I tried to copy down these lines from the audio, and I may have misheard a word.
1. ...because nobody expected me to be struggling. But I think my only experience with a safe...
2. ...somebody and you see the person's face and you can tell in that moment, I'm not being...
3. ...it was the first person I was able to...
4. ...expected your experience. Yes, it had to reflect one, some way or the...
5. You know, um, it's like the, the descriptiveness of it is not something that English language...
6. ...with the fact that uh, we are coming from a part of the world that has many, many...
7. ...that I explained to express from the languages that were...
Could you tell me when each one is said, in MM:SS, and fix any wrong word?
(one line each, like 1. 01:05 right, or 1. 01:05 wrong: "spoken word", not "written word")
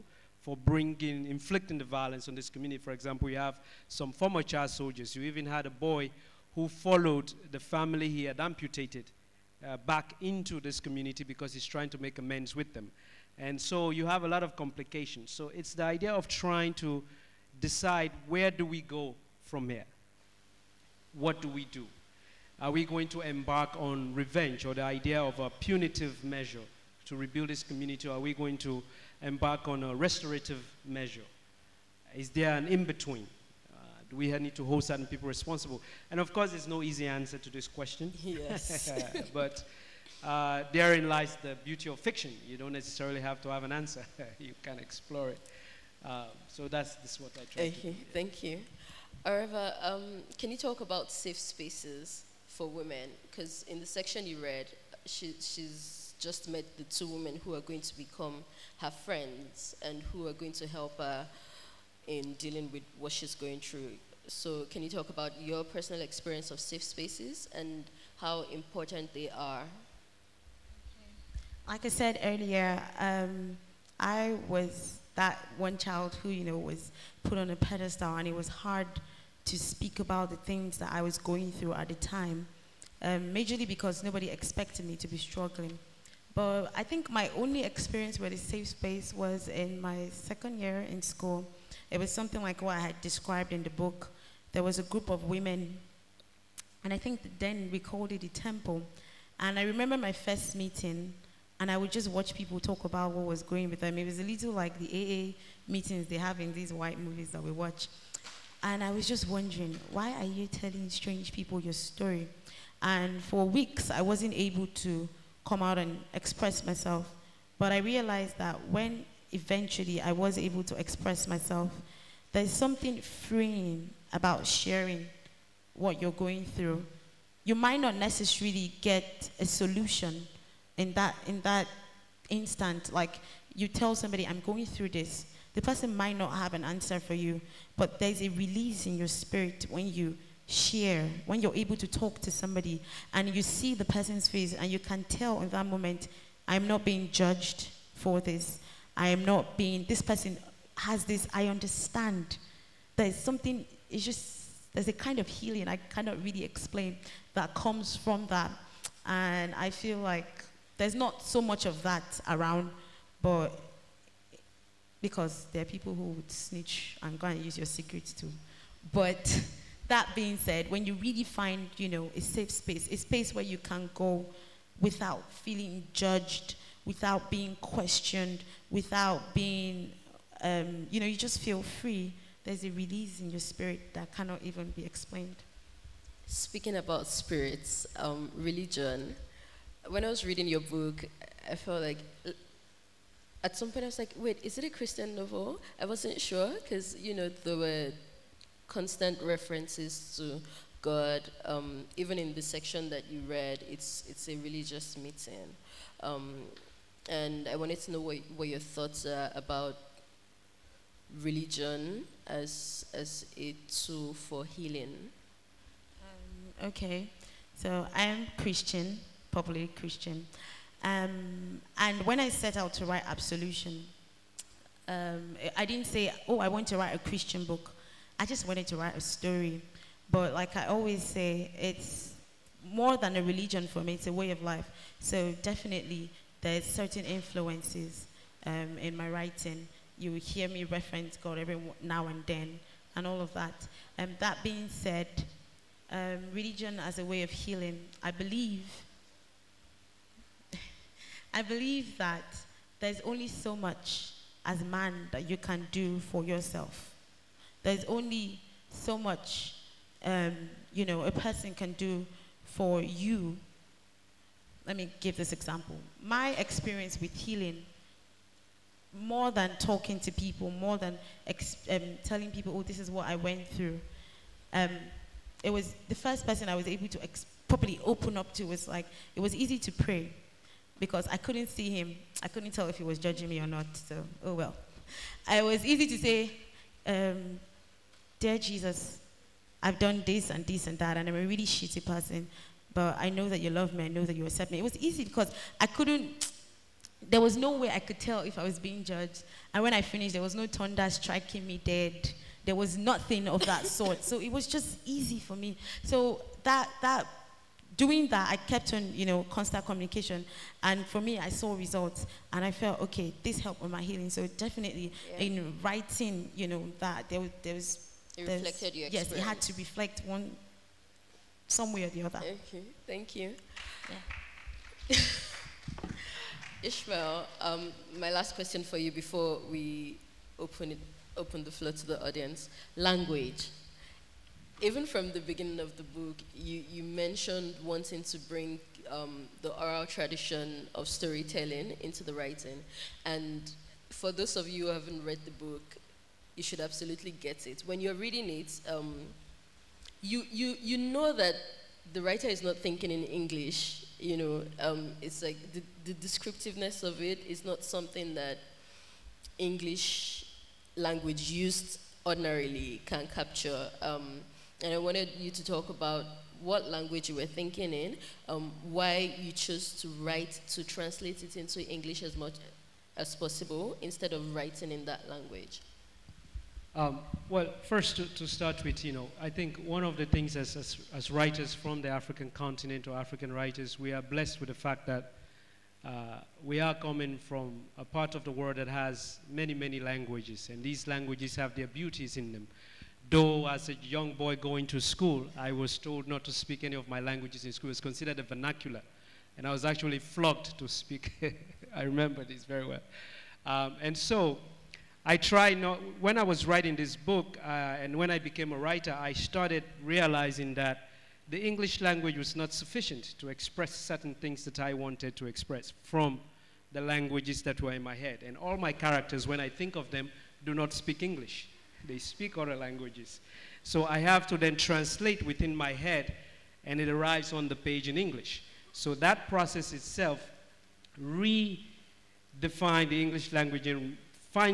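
1. 01:23 right
2. 02:22 right
3. 04:35 right
4. 05:18 wrong: "reflected", not "expected"
5. 05:53 right
6. 06:24 right
7. 06:54 wrong: "wanted", not "explained".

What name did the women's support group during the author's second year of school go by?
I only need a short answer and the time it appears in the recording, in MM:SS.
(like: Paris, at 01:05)
The temple, at 01:38.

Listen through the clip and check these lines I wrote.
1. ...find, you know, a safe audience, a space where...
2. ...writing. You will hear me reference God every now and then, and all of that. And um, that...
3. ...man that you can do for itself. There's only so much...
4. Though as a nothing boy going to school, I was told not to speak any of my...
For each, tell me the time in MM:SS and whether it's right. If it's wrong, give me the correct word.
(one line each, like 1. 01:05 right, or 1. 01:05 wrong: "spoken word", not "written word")
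1. 02:51 wrong: "space", not "audience"
2. 03:59 right
3. 04:14 wrong: "yourself", not "itself"
4. 06:33 wrong: "young", not "nothing".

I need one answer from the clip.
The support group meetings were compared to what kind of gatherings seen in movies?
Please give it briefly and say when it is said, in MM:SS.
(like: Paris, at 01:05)
AA meetings, at 01:44.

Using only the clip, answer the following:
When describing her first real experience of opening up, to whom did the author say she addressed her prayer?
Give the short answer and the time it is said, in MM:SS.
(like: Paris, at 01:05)
Jesus, at 04:48.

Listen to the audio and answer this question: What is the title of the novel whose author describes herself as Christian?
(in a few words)
Absolution.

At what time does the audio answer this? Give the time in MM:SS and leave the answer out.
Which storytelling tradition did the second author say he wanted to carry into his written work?
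05:39.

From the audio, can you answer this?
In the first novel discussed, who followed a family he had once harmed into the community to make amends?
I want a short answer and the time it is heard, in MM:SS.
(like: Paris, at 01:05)
A boy, at 00:05.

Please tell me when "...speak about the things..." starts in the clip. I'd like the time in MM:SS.
01:19.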